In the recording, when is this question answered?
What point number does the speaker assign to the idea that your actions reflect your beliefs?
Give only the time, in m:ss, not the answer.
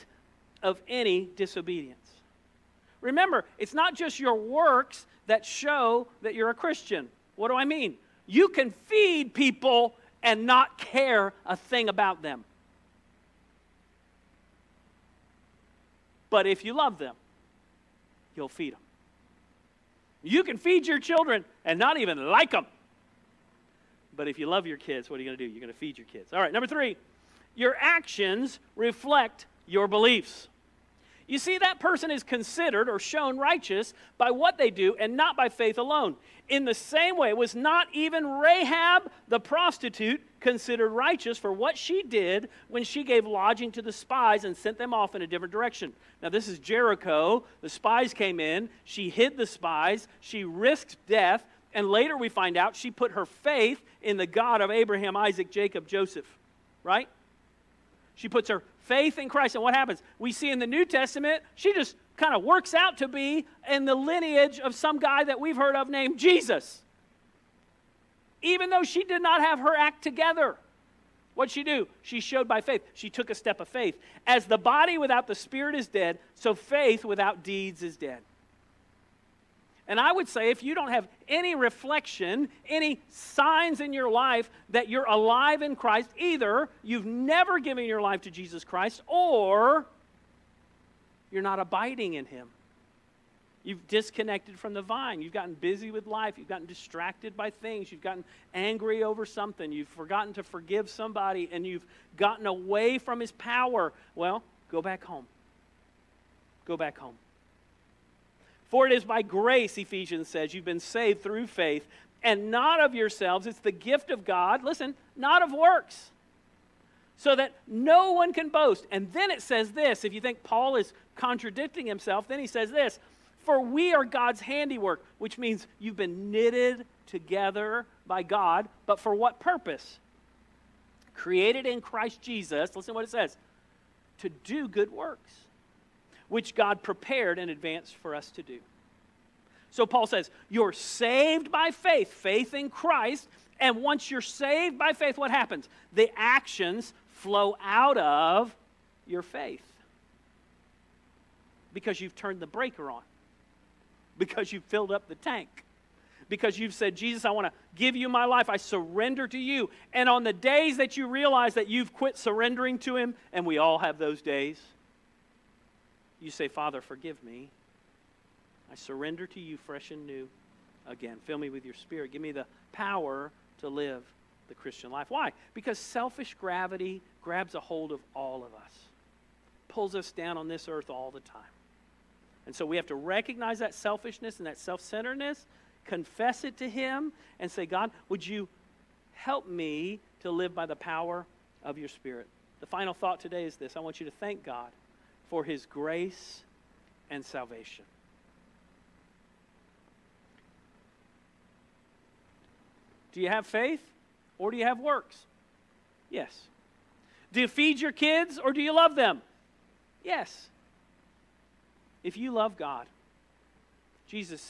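0:26.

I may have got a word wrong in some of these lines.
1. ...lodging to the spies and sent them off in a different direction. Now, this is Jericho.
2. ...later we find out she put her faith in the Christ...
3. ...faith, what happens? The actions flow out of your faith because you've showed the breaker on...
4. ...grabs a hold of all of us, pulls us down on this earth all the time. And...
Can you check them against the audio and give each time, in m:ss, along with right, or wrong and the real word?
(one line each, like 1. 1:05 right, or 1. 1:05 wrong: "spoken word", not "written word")
1. 0:43 right
2. 0:51 wrong: "God", not "Christ"
3. 2:24 wrong: "turned", not "showed"
4. 2:57 right.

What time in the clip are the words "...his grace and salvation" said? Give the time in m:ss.
3:15.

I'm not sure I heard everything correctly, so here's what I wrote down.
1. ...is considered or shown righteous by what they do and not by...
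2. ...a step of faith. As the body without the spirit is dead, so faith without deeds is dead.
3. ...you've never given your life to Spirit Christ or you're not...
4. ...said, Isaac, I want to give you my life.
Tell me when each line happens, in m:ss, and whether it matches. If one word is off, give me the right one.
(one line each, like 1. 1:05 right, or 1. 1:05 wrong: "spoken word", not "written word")
1. 0:32 right
2. 1:13 right
3. 1:26 wrong: "Jesus", not "Spirit"
4. 2:36 wrong: "Jesus", not "Isaac".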